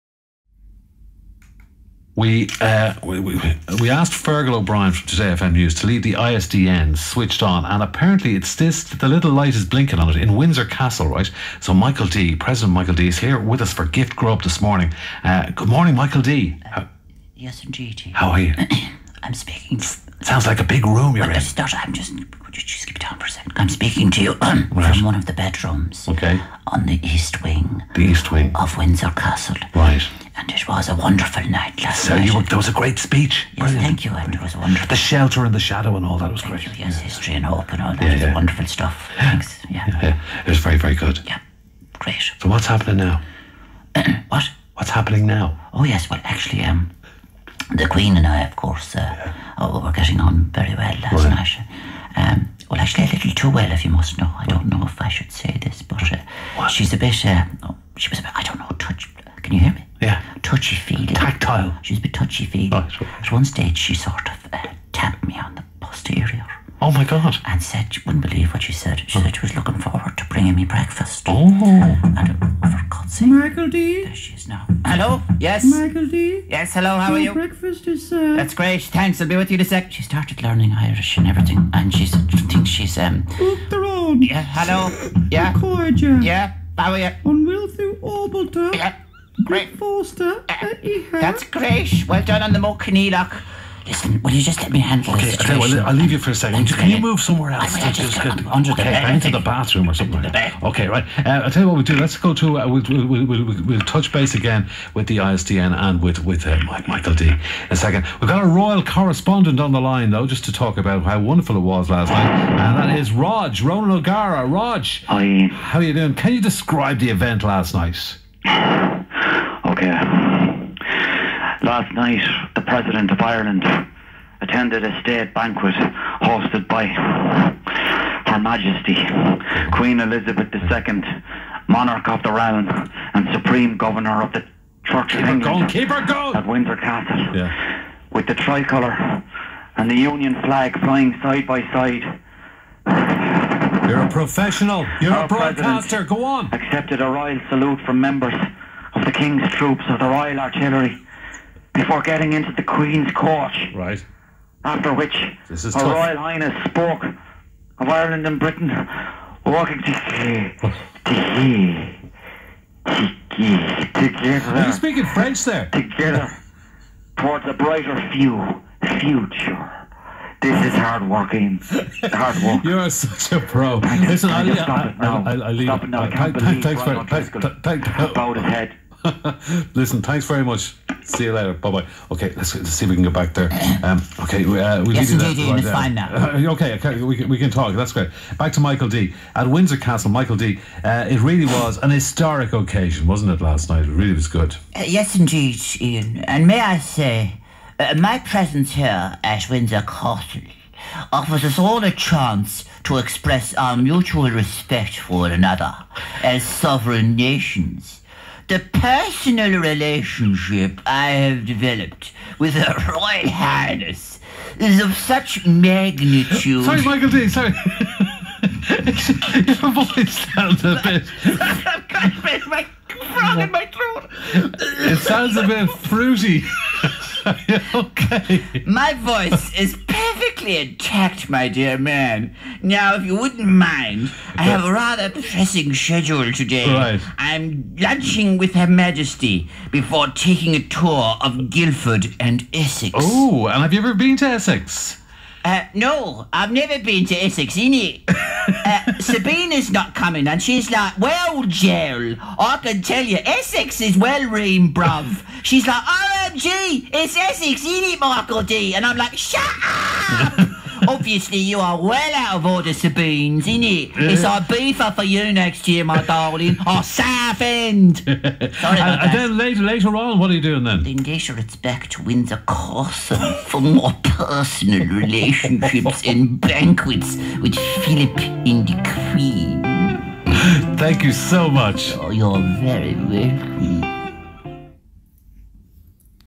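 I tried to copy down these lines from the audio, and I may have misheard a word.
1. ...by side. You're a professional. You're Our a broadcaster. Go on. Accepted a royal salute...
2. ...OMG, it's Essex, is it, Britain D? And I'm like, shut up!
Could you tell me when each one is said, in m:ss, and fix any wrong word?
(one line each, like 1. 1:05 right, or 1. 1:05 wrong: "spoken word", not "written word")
1. 2:21 right
2. 4:16 wrong: "Michael", not "Britain".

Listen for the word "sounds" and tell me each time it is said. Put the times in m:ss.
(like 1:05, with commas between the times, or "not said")
0:20, 3:40, 3:44.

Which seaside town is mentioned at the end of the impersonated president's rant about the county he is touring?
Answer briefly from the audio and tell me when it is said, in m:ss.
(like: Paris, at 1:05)
Southend, at 4:26.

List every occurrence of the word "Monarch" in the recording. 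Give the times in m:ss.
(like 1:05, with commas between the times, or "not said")
2:11.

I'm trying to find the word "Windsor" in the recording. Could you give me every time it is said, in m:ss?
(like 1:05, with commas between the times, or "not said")
0:10, 0:28, 2:16, 3:09, 3:19, 4:31.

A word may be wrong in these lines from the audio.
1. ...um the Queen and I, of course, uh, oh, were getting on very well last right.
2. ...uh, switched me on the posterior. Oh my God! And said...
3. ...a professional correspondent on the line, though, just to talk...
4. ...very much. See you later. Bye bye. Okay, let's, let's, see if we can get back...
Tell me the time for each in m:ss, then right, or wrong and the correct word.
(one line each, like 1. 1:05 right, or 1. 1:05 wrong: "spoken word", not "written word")
1. 0:46 right
2. 1:04 wrong: "tapped", not "switched"
3. 1:48 wrong: "royal", not "professional"
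4. 3:00 right.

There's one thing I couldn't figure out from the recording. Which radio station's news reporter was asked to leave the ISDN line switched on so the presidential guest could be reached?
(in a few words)
Today FM.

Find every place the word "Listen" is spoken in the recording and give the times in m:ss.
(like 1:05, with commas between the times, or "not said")
1:33, 2:53, 2:59.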